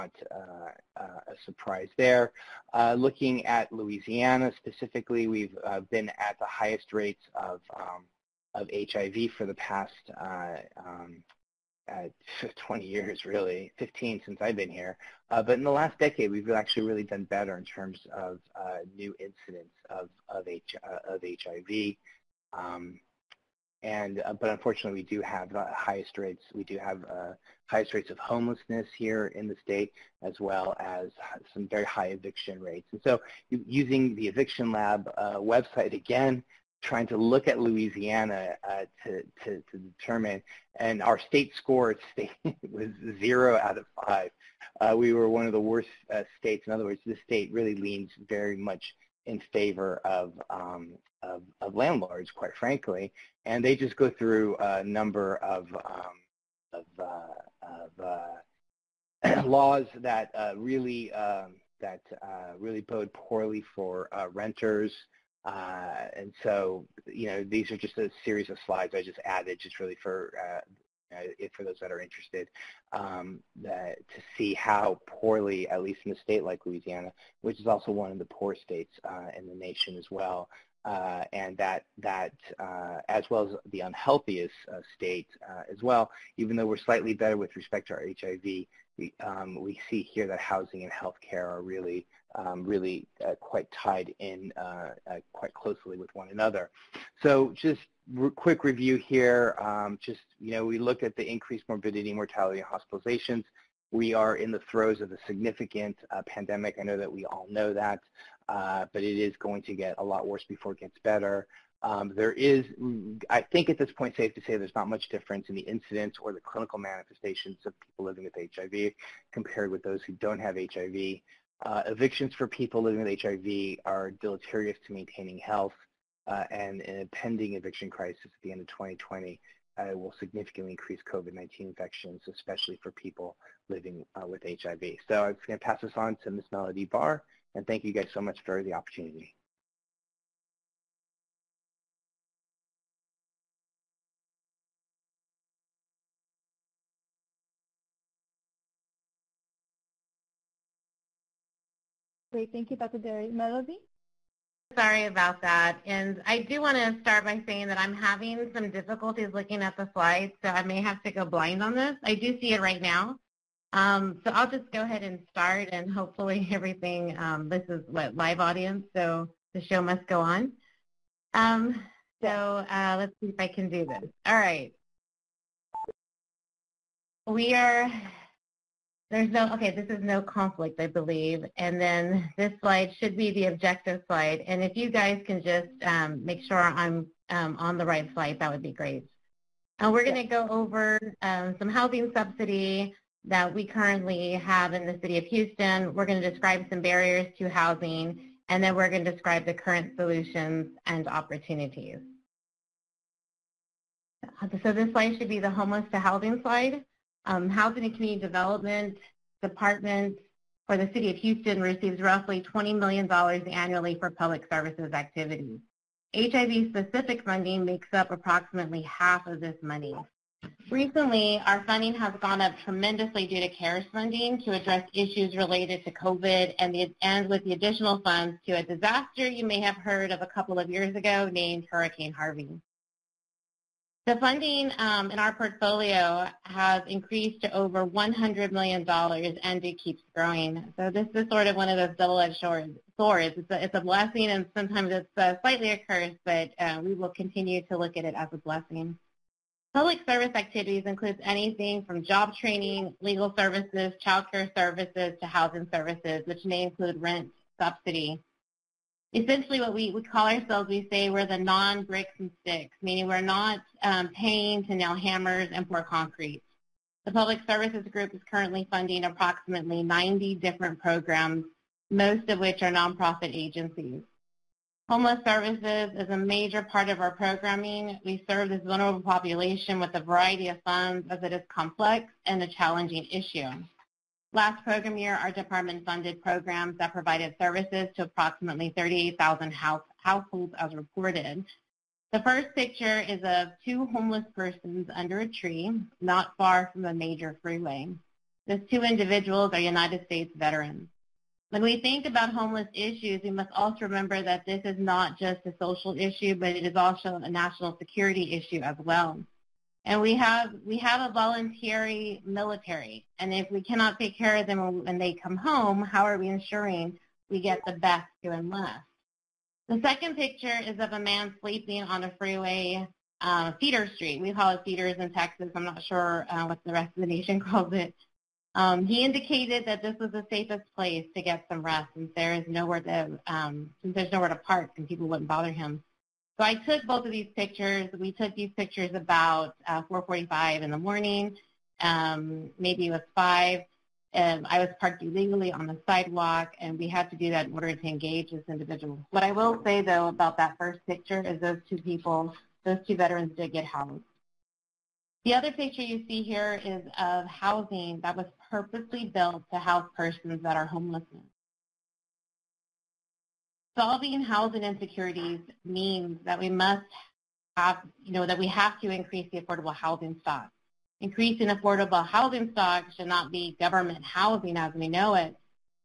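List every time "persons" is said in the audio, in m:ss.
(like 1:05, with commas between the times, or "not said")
4:54, 5:59.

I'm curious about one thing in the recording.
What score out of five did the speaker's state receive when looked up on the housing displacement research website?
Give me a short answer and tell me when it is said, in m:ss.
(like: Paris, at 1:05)
0, at 0:43.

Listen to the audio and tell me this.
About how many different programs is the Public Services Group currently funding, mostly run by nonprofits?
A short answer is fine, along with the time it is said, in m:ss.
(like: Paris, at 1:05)
90, at 4:29.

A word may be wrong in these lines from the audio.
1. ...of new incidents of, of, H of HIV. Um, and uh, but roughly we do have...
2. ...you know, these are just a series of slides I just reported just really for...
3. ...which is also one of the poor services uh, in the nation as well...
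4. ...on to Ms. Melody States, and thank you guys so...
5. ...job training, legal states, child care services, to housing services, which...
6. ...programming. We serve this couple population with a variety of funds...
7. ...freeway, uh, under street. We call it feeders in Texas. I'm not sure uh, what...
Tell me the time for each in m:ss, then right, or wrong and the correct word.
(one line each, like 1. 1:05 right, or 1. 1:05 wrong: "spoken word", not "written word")
1. 0:18 wrong: "unfortunately", not "roughly"
2. 1:07 wrong: "added", not "reported"
3. 1:17 wrong: "states", not "services"
4. 2:15 wrong: "Barr", not "States"
5. 4:12 wrong: "services", not "states"
6. 4:37 wrong: "vulnerable", not "couple"
7. 5:22 wrong: "feeder", not "under".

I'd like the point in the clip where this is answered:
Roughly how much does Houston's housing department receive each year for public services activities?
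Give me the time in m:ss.
3:32.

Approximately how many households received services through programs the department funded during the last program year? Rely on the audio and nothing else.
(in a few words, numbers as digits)
38,000.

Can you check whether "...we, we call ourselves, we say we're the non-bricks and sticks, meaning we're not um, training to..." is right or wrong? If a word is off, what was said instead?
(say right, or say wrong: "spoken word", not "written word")
wrong: "paying", not "training".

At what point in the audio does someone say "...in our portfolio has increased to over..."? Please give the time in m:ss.
3:55.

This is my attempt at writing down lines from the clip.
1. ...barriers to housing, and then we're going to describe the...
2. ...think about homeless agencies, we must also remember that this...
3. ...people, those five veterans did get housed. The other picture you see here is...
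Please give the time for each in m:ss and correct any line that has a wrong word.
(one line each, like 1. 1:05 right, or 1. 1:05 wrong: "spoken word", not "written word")
1. 3:16 right
2. 5:01 wrong: "issues", not "agencies"
3. 5:51 wrong: "two", not "five".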